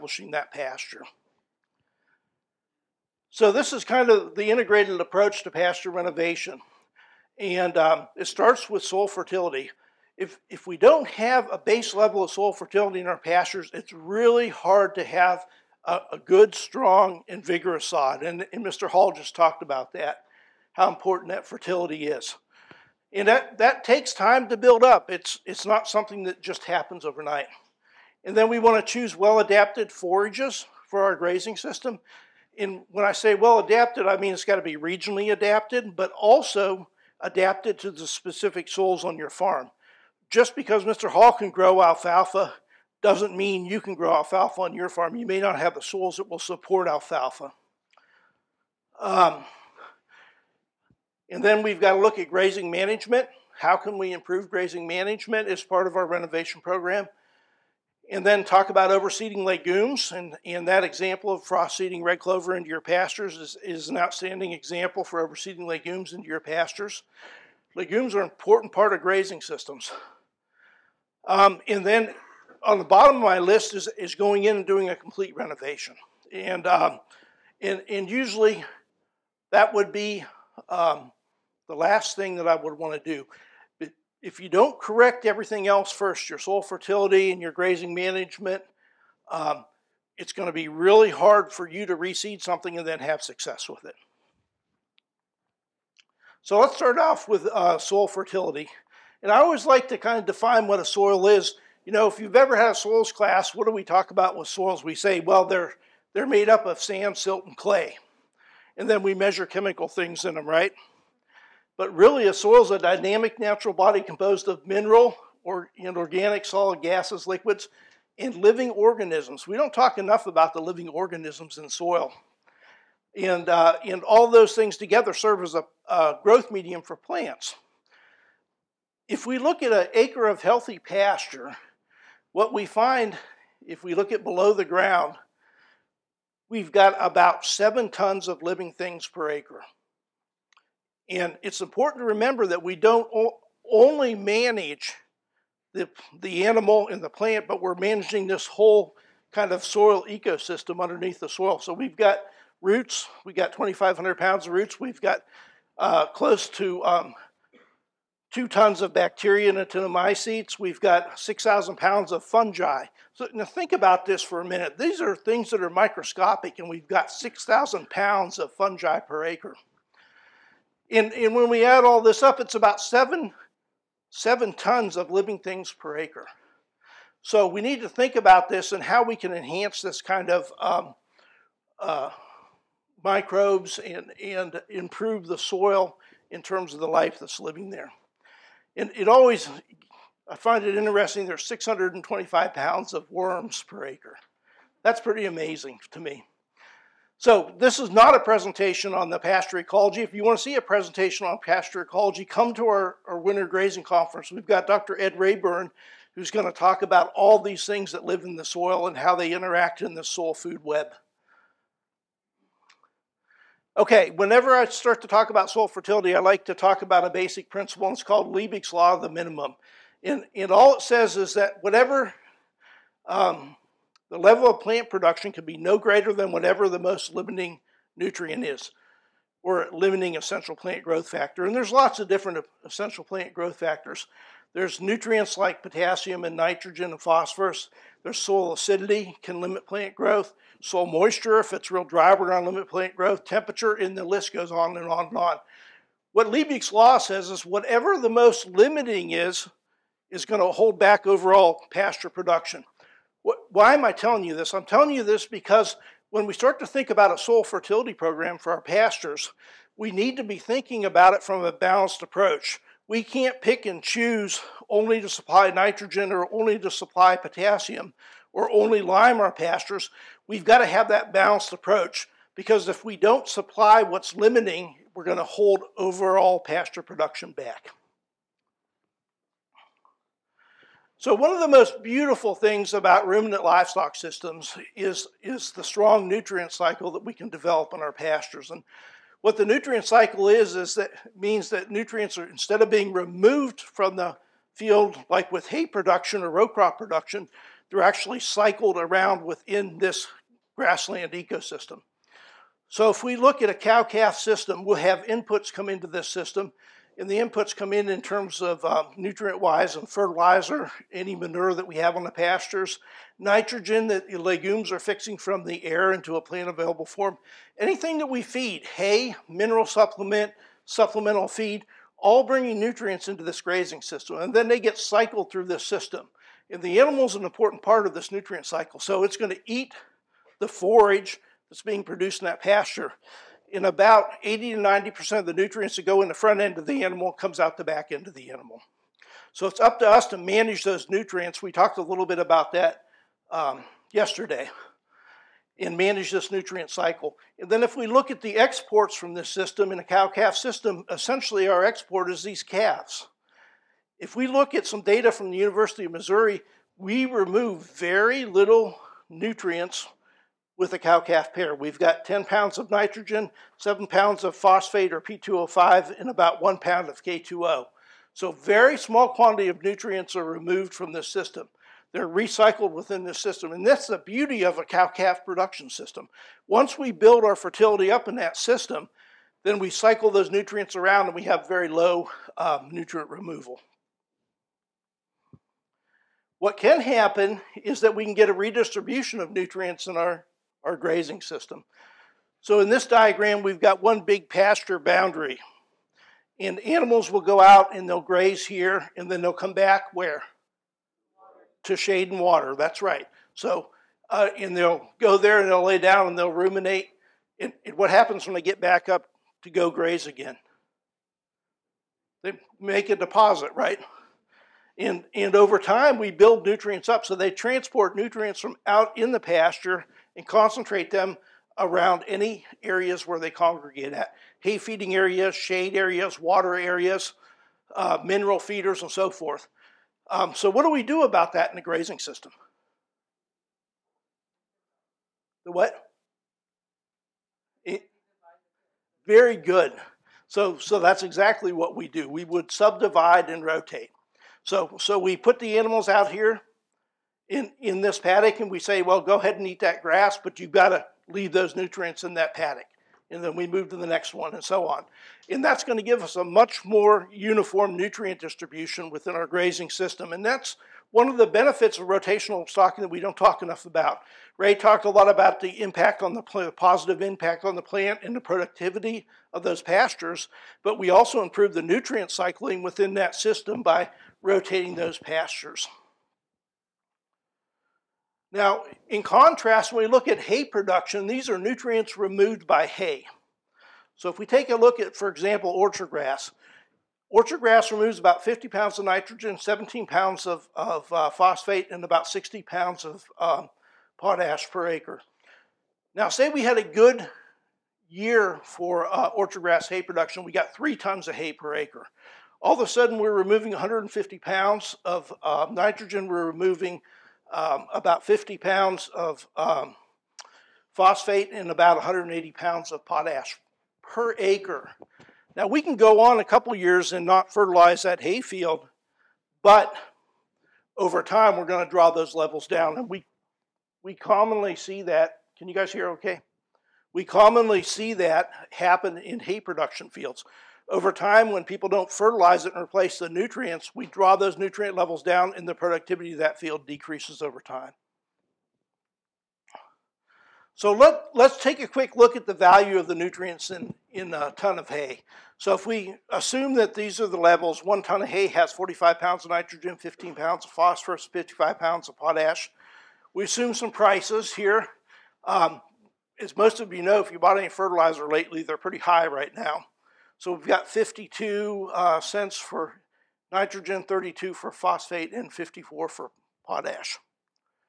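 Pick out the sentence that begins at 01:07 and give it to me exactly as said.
Legumes are an important part of grazing systems.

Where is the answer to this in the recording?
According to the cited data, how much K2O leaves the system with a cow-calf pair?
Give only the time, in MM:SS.
06:06.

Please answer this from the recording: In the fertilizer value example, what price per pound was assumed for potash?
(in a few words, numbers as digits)
54 cents.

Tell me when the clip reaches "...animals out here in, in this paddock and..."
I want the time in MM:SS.
07:25.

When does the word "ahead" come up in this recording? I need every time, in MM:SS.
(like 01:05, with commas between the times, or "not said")
07:29.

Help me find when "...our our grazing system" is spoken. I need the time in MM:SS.
06:29.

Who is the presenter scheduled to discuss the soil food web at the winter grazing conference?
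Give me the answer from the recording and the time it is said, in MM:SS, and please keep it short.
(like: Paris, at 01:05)
Dr. Ed Rayburn, at 03:24.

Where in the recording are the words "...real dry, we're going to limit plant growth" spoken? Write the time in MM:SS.
04:01.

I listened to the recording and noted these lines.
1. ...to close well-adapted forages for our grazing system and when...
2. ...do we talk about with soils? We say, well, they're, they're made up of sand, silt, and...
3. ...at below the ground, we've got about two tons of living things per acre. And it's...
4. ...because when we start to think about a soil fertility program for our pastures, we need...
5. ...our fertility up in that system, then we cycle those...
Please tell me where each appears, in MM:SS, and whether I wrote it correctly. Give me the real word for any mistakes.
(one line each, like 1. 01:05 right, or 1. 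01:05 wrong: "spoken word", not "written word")
1. 00:28 wrong: "choose", not "close"
2. 01:43 right
3. 02:14 wrong: "seven", not "two"
4. 04:15 right
5. 06:17 right.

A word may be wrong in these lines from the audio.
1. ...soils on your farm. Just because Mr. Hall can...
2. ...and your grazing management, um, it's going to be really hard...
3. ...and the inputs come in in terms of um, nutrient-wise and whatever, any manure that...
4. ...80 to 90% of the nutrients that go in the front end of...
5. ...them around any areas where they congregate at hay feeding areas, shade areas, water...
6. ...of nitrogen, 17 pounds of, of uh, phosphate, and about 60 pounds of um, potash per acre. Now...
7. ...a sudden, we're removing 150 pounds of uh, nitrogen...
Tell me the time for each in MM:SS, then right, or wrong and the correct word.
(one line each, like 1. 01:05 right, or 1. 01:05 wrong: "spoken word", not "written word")
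1. 00:38 right
2. 01:27 right
3. 05:07 wrong: "fertilizer", not "whatever"
4. 05:34 right
5. 07:00 right
6. 08:08 right
7. 08:22 right.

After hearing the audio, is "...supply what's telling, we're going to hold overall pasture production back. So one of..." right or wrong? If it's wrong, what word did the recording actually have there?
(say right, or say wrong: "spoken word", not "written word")
wrong: "limiting", not "telling".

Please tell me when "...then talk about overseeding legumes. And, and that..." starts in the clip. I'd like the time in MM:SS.
00:58.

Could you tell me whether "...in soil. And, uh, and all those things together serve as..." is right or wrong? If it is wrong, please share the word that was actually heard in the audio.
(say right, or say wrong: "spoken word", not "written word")
right.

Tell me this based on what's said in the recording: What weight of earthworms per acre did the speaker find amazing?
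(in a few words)
625 pounds.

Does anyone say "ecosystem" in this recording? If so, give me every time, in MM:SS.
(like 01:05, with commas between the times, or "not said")
02:30, 05:01.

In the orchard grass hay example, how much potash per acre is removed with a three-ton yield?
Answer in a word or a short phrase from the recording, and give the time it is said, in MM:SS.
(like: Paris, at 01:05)
180 pounds, at 08:31.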